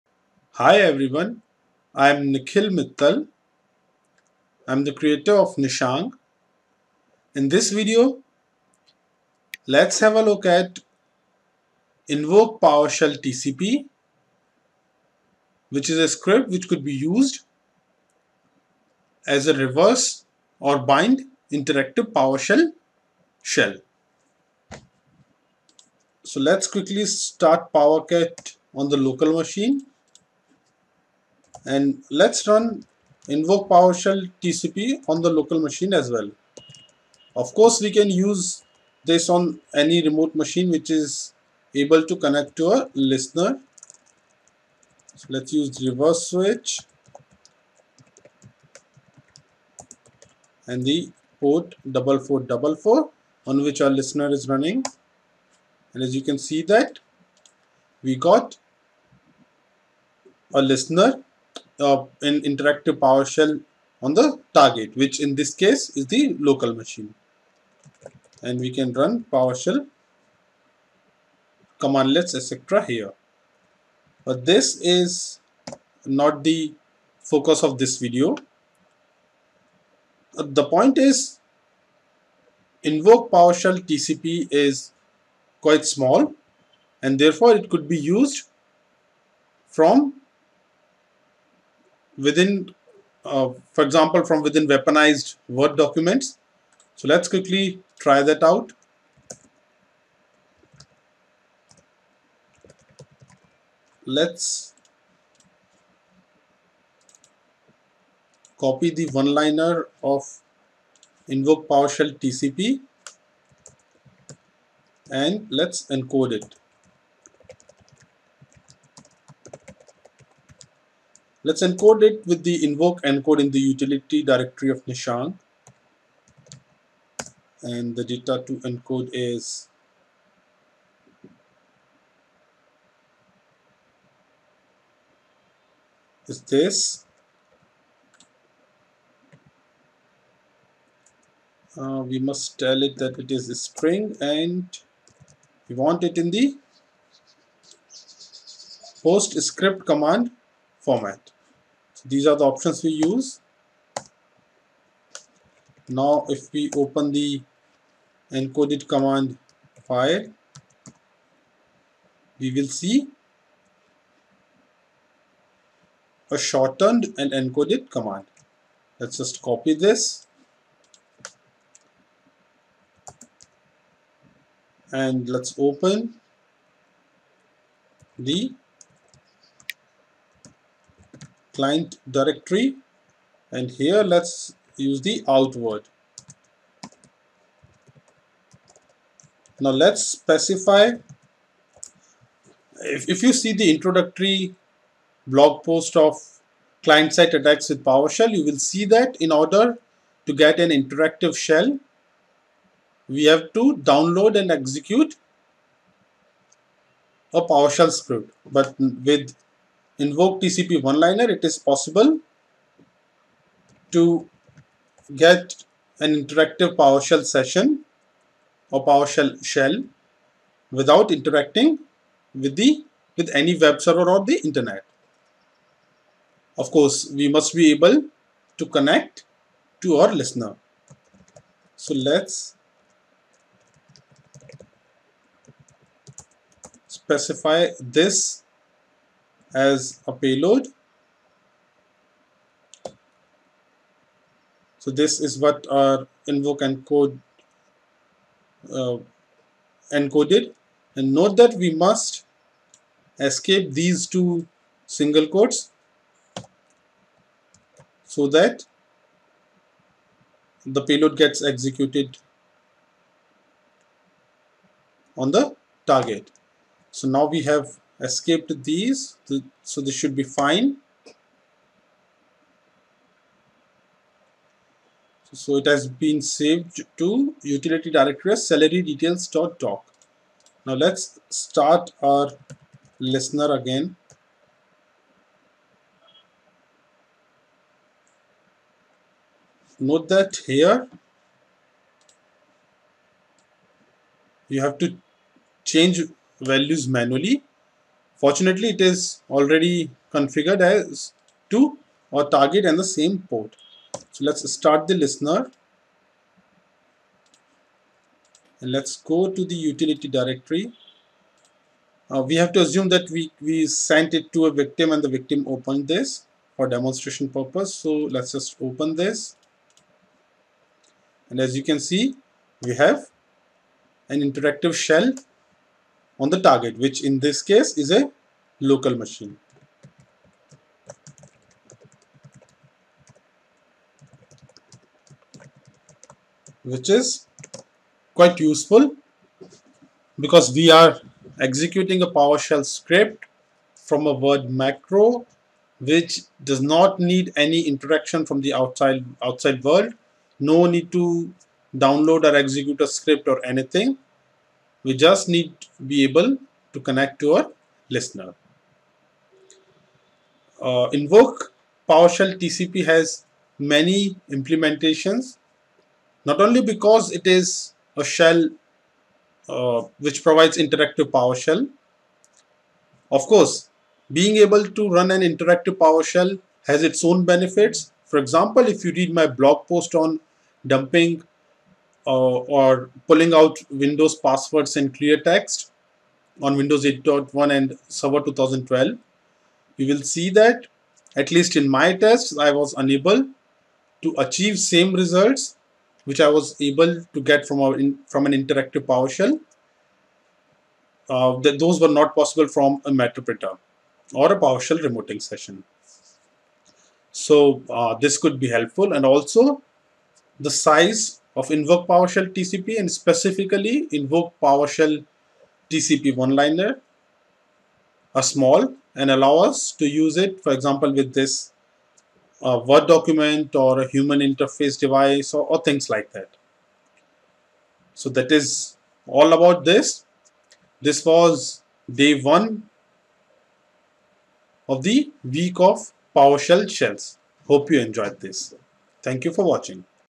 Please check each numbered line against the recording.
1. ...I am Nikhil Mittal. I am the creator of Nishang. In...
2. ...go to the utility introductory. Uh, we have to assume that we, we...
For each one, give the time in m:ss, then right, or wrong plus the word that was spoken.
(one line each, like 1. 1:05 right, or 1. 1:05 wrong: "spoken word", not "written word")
1. 0:01 right
2. 5:08 wrong: "directory", not "introductory".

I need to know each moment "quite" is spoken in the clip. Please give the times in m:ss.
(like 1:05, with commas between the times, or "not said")
1:25, 5:38.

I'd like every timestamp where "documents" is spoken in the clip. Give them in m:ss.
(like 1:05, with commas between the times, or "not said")
1:35, 7:02.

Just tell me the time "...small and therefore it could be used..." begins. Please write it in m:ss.
1:25.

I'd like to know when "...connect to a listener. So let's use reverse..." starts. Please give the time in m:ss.
0:42.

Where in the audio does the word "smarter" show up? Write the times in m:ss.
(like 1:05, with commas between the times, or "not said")
not said.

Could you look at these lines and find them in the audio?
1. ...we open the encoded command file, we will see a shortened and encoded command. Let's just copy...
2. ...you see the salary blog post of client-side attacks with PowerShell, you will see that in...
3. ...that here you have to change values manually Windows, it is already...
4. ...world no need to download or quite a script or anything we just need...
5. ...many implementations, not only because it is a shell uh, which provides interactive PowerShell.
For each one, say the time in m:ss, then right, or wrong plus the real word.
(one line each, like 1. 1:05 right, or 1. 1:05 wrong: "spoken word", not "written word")
1. 2:36 right
2. 3:13 wrong: "introductory", not "salary"
3. 4:50 wrong: "Fortunately", not "Windows"
4. 5:49 wrong: "execute", not "quite"
5. 6:03 right.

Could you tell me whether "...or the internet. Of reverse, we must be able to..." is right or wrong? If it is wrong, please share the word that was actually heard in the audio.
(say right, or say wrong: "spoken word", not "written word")
wrong: "course", not "reverse".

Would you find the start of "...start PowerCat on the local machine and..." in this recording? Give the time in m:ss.
0:27.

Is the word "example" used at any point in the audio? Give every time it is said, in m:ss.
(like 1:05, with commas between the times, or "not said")
1:33, 6:18, 7:00.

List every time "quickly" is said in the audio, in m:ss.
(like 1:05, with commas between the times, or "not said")
0:26, 1:37.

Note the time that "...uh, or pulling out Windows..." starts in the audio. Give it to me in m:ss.
6:22.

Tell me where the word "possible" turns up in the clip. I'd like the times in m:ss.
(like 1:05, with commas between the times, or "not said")
3:31, 6:42.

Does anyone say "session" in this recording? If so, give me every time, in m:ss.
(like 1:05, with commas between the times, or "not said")
3:37, 6:45.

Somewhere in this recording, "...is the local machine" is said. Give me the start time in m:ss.
1:05.